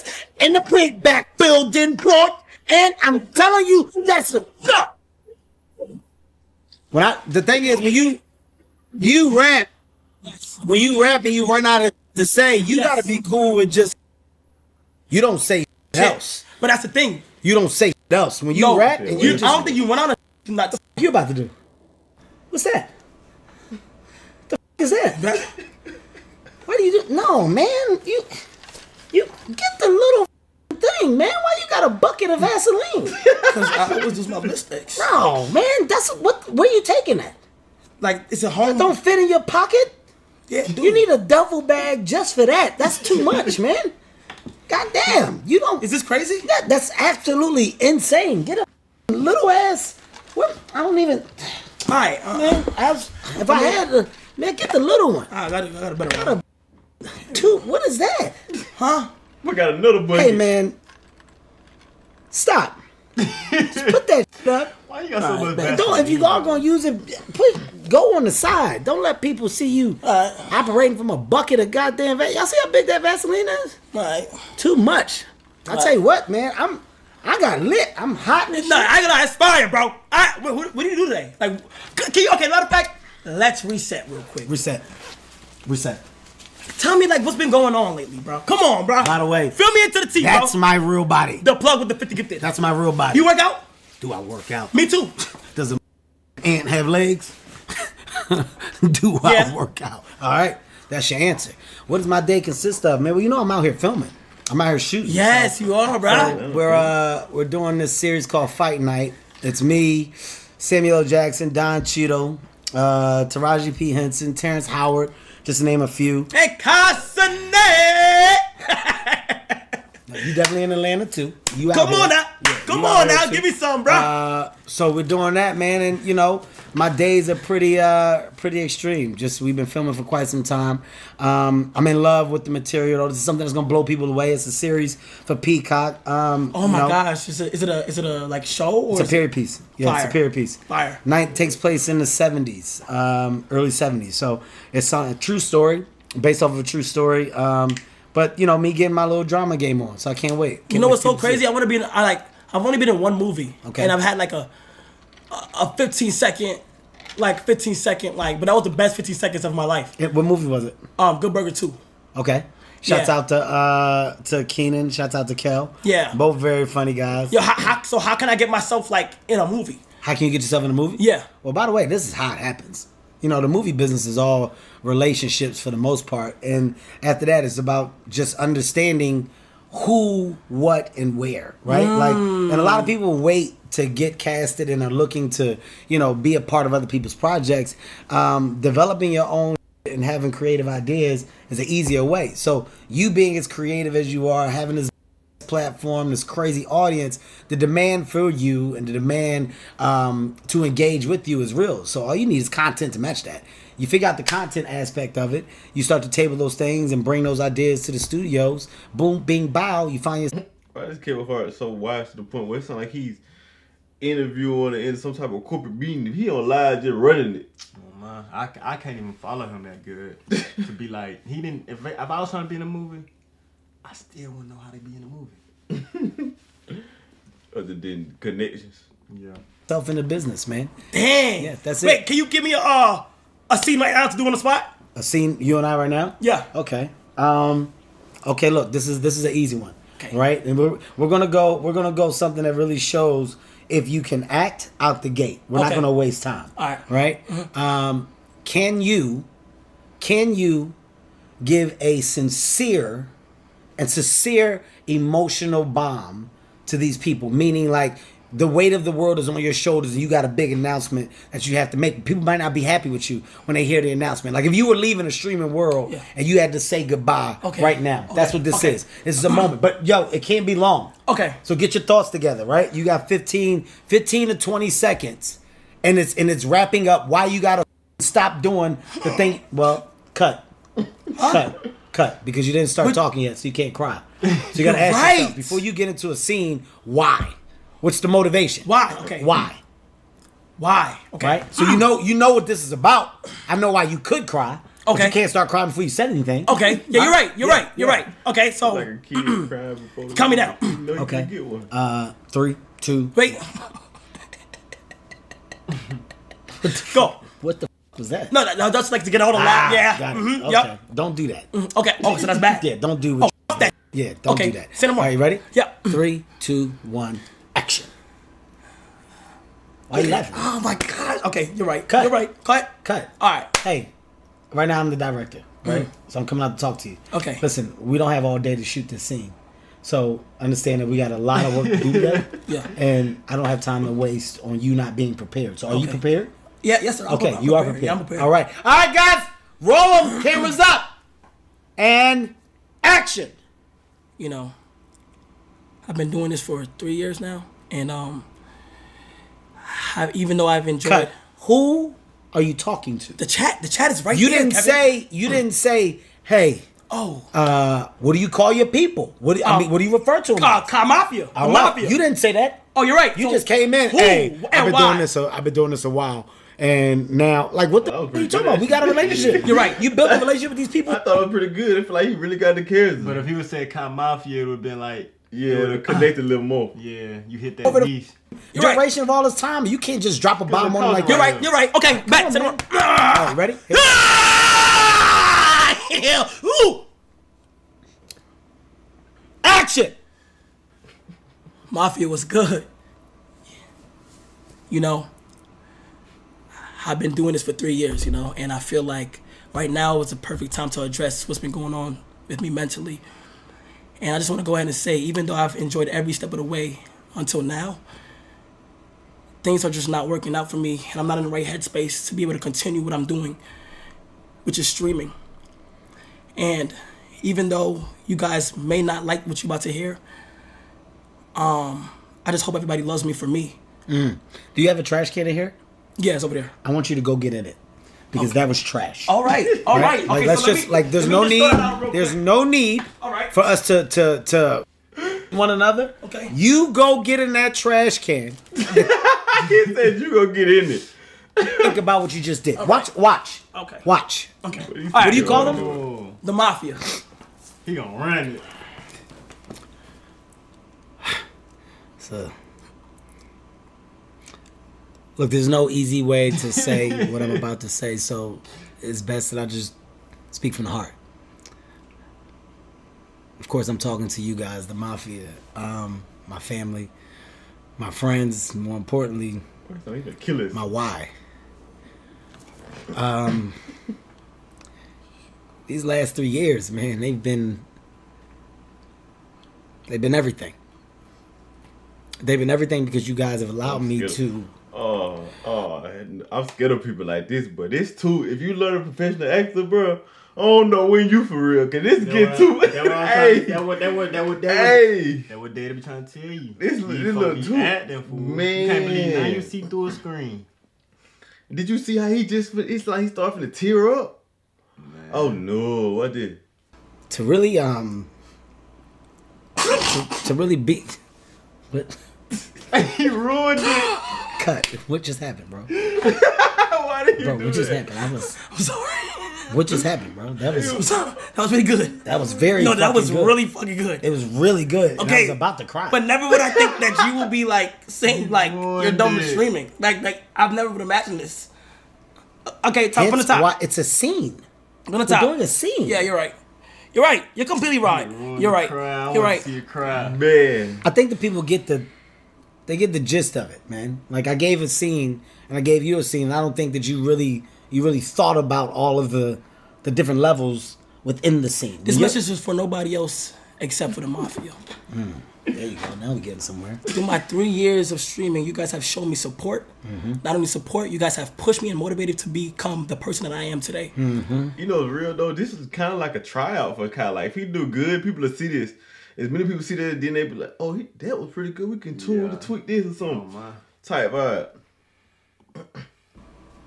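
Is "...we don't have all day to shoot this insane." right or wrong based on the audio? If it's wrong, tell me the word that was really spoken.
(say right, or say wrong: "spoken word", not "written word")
wrong: "scene", not "insane".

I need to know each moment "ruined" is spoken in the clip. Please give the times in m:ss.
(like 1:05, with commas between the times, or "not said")
8:33.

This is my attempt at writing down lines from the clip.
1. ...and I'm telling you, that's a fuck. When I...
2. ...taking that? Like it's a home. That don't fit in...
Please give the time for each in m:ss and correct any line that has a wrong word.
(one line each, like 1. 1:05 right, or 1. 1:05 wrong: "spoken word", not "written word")
1. 0:02 right
2. 0:36 right.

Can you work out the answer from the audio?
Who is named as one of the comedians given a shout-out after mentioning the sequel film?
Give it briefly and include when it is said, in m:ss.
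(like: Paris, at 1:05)
Kenan, at 2:44.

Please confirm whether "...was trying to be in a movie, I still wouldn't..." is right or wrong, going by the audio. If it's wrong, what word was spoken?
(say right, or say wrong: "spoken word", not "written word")
right.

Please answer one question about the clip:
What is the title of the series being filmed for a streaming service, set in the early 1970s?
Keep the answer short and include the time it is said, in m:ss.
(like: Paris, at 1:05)
Fight Night, at 1:48.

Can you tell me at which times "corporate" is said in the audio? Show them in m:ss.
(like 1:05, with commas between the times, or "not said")
3:35.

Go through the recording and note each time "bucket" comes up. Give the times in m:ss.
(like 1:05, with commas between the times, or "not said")
0:31, 1:11.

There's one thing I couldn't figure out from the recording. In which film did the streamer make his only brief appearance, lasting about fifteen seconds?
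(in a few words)
Good Burger 2.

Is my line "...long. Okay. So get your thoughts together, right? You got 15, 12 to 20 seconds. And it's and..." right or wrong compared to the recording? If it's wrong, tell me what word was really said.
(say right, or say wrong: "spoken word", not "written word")
wrong: "15", not "12".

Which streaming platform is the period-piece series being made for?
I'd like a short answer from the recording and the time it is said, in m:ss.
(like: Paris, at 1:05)
Peacock, at 2:15.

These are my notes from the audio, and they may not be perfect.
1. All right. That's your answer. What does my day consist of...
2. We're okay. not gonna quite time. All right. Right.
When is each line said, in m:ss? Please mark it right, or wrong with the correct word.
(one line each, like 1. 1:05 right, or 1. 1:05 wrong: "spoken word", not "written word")
1. 1:40 right
2. 4:05 wrong: "waste", not "quite".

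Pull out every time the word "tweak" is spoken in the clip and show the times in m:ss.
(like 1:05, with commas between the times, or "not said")
9:32.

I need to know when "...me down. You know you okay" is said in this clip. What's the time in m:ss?
5:00.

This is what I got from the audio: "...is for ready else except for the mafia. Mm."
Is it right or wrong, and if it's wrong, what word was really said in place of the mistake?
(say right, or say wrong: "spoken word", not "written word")
wrong: "nobody", not "ready".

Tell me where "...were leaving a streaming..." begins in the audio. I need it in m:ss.
4:24.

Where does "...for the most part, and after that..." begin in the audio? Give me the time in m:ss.
2:55.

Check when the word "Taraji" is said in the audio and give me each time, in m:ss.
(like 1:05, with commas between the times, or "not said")
1:53.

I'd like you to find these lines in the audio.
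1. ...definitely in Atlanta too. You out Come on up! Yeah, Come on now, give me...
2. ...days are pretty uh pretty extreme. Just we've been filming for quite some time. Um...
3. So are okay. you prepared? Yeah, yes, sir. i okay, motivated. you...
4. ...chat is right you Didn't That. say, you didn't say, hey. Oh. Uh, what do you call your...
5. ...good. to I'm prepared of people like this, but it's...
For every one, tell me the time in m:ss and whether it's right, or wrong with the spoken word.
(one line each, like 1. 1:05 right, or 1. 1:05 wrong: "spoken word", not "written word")
1. 2:00 right
2. 2:06 right
3. 5:35 wrong: "prepared", not "motivated"
4. 5:53 wrong: "Kevin", not "That"
5. 8:03 wrong: "scared", not "prepared".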